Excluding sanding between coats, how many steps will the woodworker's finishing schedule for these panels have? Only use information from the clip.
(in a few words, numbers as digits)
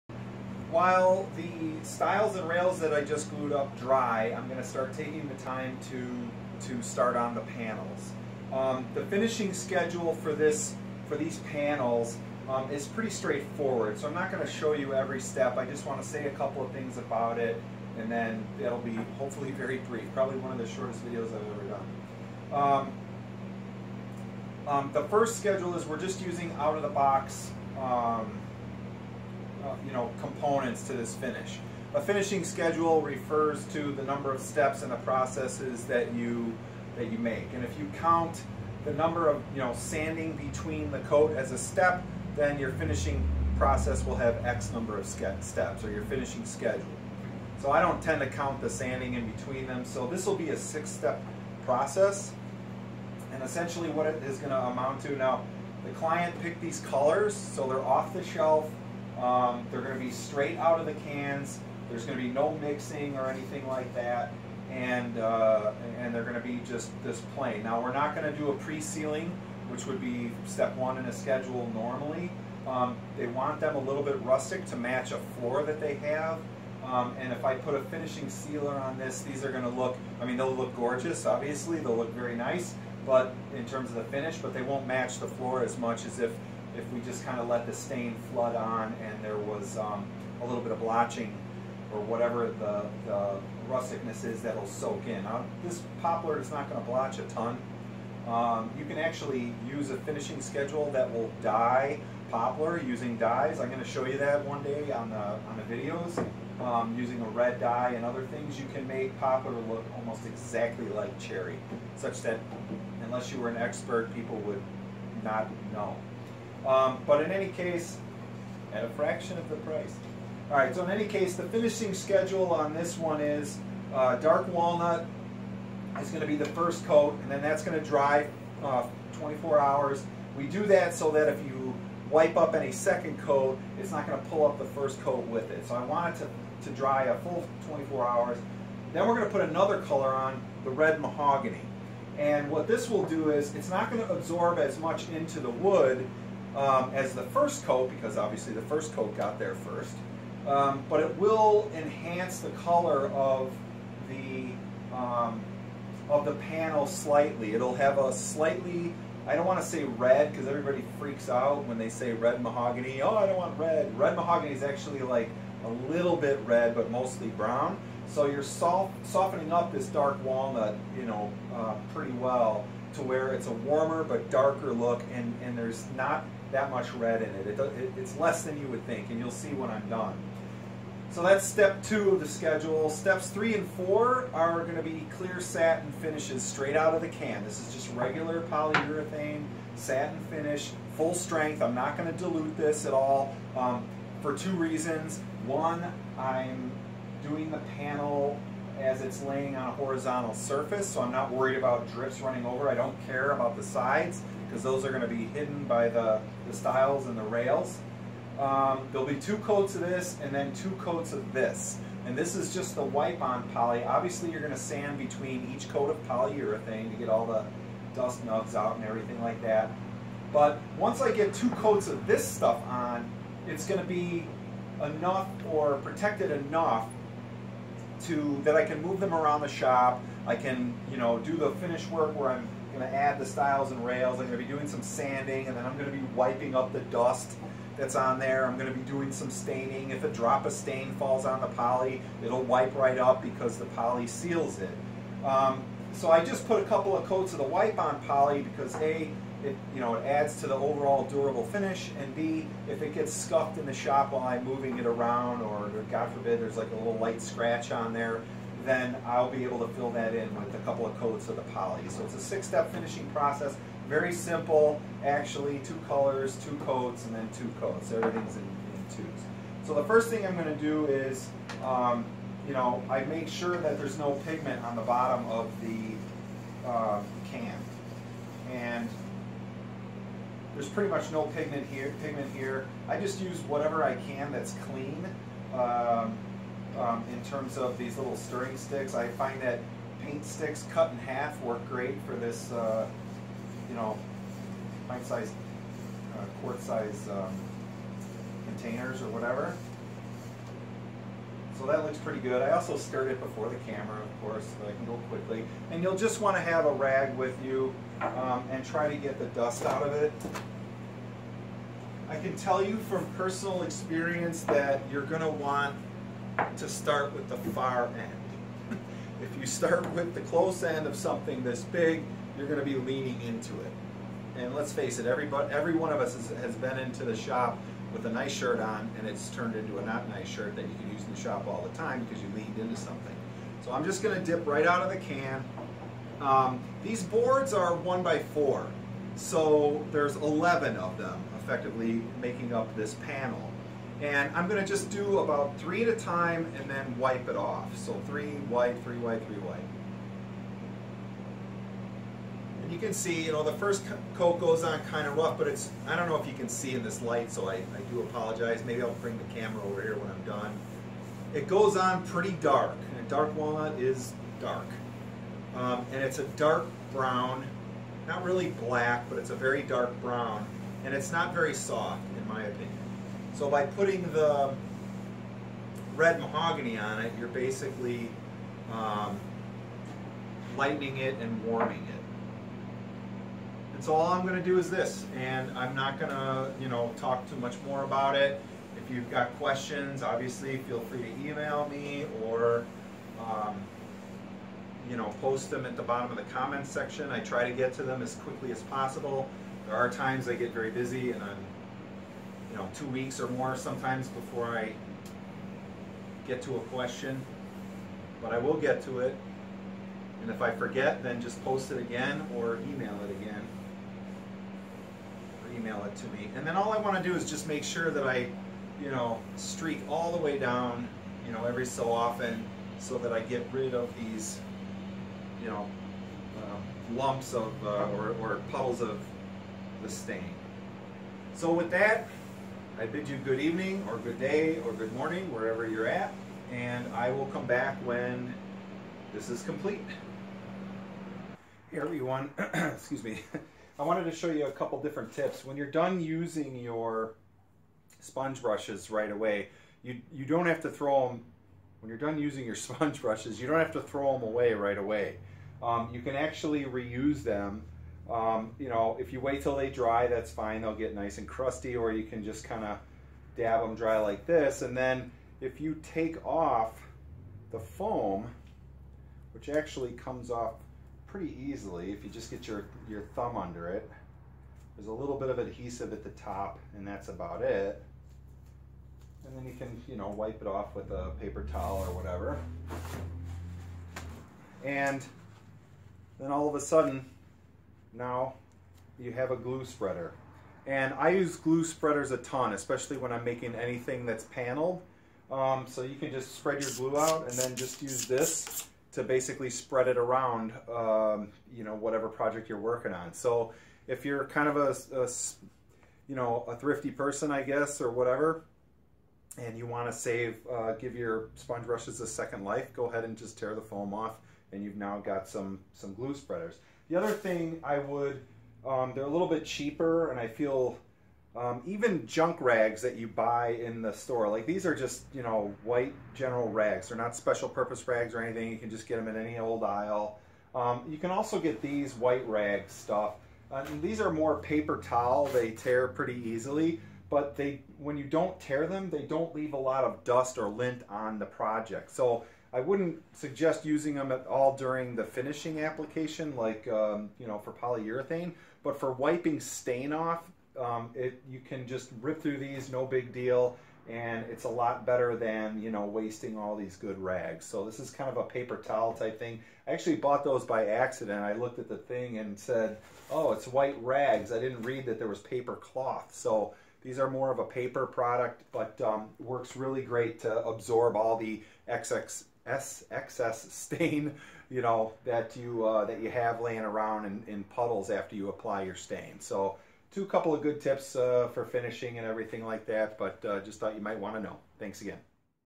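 6.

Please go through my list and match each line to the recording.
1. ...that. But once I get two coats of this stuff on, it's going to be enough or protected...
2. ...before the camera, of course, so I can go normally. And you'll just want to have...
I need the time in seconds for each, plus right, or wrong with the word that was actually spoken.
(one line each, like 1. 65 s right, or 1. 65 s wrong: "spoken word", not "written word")
1. 219 s right
2. 303 s wrong: "quickly", not "normally".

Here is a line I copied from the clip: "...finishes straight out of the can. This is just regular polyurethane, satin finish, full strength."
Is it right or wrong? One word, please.
right.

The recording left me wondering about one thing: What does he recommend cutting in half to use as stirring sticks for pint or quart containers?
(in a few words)
Paint sticks.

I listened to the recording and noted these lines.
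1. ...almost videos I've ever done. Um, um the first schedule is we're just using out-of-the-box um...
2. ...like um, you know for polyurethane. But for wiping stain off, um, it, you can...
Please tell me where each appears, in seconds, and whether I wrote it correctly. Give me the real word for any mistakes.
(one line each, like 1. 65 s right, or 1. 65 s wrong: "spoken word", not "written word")
1. 20 s wrong: "shortest", not "almost"
2. 546 s right.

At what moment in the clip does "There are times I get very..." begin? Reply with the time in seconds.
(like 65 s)
399 s.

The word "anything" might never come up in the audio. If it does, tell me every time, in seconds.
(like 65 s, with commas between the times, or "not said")
63 s, 493 s, 528 s.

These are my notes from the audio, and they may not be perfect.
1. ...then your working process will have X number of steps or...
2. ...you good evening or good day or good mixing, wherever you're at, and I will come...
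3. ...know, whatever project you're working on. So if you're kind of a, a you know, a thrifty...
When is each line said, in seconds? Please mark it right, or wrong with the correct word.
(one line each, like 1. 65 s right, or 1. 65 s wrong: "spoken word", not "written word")
1. 42 s wrong: "finishing", not "working"
2. 433 s wrong: "morning", not "mixing"
3. 501 s right.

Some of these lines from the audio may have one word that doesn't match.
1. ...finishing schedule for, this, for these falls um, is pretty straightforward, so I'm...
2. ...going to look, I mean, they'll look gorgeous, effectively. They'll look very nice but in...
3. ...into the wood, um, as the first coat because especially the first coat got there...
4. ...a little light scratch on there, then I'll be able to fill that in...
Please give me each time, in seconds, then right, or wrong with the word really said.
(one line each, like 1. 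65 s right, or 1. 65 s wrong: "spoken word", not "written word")
1. 9 s wrong: "panels", not "falls"
2. 79 s wrong: "obviously", not "effectively"
3. 145 s wrong: "obviously", not "especially"
4. 256 s right.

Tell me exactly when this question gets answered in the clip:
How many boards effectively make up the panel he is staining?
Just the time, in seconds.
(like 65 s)
340 s.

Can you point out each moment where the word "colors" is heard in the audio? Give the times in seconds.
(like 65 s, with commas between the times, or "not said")
56 s, 139 s, 152 s, 265 s.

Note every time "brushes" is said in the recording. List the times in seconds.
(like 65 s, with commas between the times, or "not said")
448 s, 453 s, 511 s.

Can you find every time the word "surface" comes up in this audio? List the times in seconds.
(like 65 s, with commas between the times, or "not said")
200 s.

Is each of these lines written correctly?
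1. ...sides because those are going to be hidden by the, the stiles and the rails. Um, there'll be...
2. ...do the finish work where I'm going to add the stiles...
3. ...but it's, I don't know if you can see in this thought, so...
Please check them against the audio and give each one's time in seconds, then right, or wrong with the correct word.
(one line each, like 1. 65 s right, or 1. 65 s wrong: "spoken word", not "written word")
1. 203 s right
2. 231 s right
3. 355 s wrong: "light", not "thought".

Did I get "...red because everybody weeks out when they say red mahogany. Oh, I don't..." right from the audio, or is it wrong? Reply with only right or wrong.
wrong.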